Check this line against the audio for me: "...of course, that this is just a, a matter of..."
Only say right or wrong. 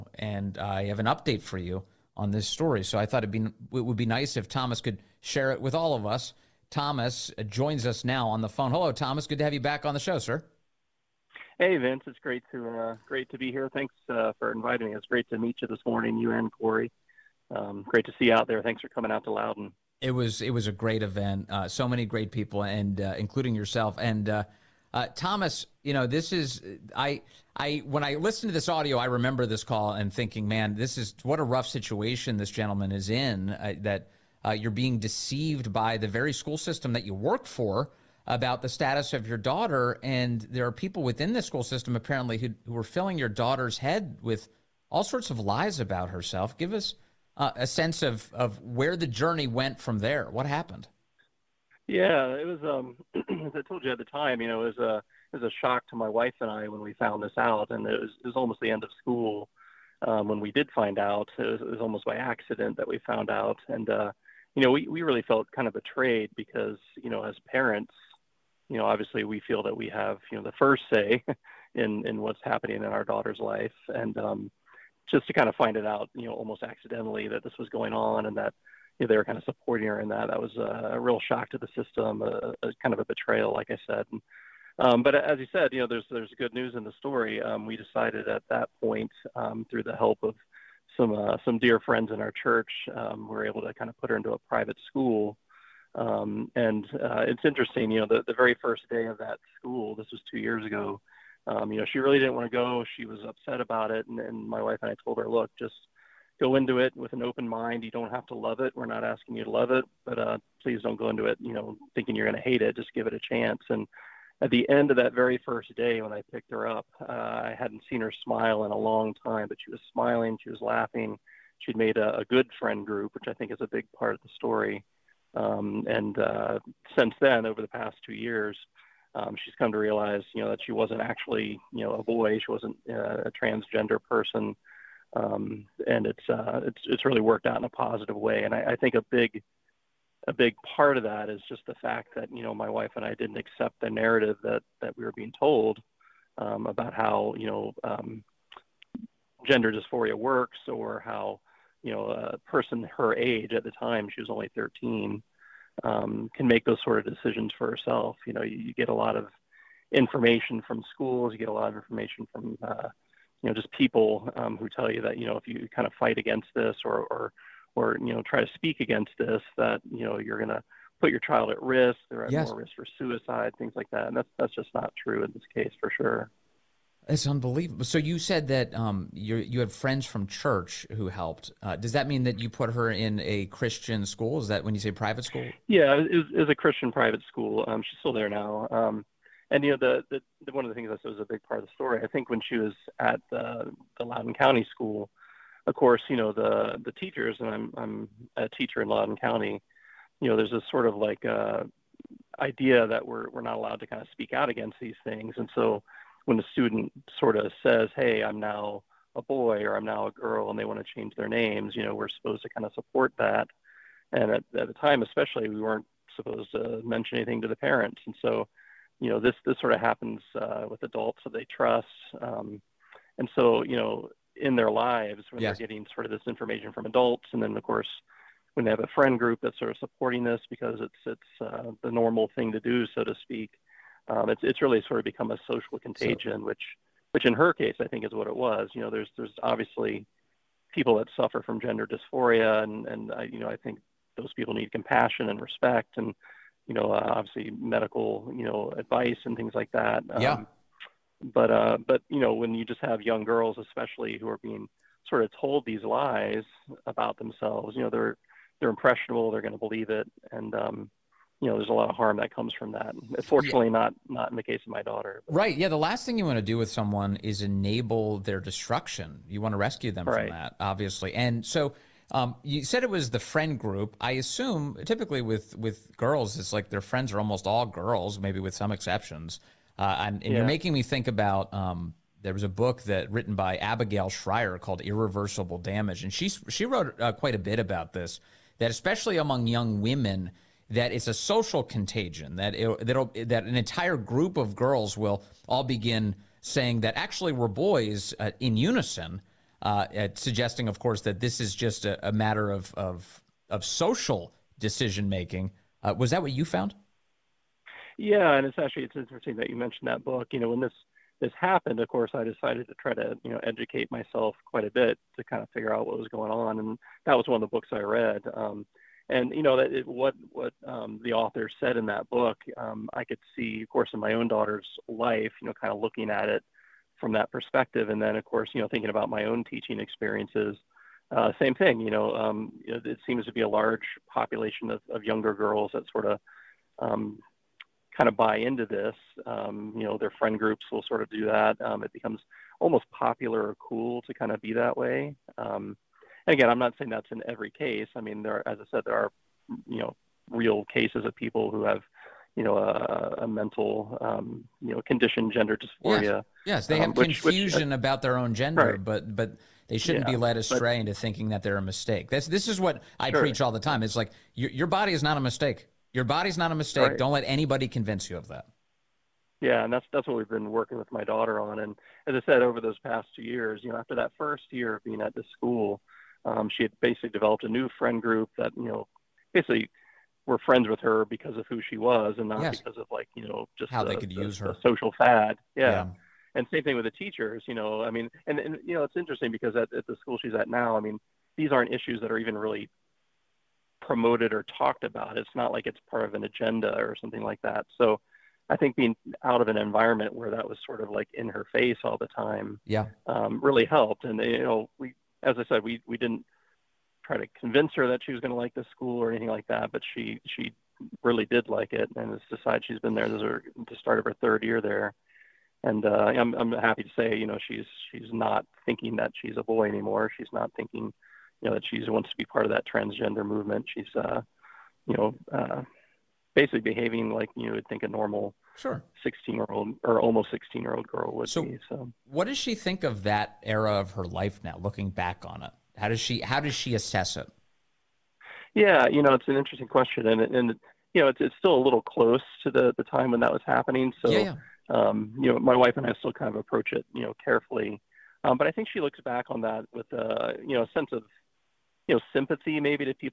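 right.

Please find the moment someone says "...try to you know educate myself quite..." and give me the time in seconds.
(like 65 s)
312 s.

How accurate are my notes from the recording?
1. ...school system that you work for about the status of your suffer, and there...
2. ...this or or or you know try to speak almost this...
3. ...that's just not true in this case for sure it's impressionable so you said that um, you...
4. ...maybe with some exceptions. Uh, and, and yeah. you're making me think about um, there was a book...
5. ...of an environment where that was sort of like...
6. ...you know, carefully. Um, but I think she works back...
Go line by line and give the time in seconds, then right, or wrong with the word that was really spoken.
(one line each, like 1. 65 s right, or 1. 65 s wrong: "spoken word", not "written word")
1. 36 s wrong: "daughter", not "suffer"
2. 166 s wrong: "against", not "almost"
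3. 174 s wrong: "unbelievable", not "impressionable"
4. 278 s right
5. 399 s right
6. 446 s wrong: "looks", not "works".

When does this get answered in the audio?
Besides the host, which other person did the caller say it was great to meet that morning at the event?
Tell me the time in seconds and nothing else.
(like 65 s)
16 s.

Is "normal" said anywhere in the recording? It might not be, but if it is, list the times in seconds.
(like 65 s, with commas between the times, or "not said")
231 s, 427 s.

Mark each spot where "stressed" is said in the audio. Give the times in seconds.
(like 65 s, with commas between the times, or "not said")
not said.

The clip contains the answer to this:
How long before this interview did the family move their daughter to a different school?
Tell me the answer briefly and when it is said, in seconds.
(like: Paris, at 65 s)
two years ago, at 100 s.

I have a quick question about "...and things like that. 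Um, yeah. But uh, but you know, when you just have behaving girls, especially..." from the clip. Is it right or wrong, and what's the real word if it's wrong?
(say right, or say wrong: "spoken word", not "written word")
wrong: "young", not "behaving".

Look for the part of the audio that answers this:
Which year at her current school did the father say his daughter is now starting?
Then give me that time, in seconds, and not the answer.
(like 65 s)
414 s.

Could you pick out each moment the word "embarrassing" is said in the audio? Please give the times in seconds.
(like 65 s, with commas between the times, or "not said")
not said.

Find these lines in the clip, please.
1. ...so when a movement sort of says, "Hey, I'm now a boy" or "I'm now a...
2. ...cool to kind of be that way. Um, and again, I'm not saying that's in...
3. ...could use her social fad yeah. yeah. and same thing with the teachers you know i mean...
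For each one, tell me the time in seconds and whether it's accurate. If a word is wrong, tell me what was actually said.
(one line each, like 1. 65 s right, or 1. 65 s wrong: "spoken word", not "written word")
1. 205 s wrong: "student", not "movement"
2. 343 s right
3. 383 s right.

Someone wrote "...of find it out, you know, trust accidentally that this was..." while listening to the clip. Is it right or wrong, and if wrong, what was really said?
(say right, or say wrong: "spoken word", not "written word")
wrong: "almost", not "trust".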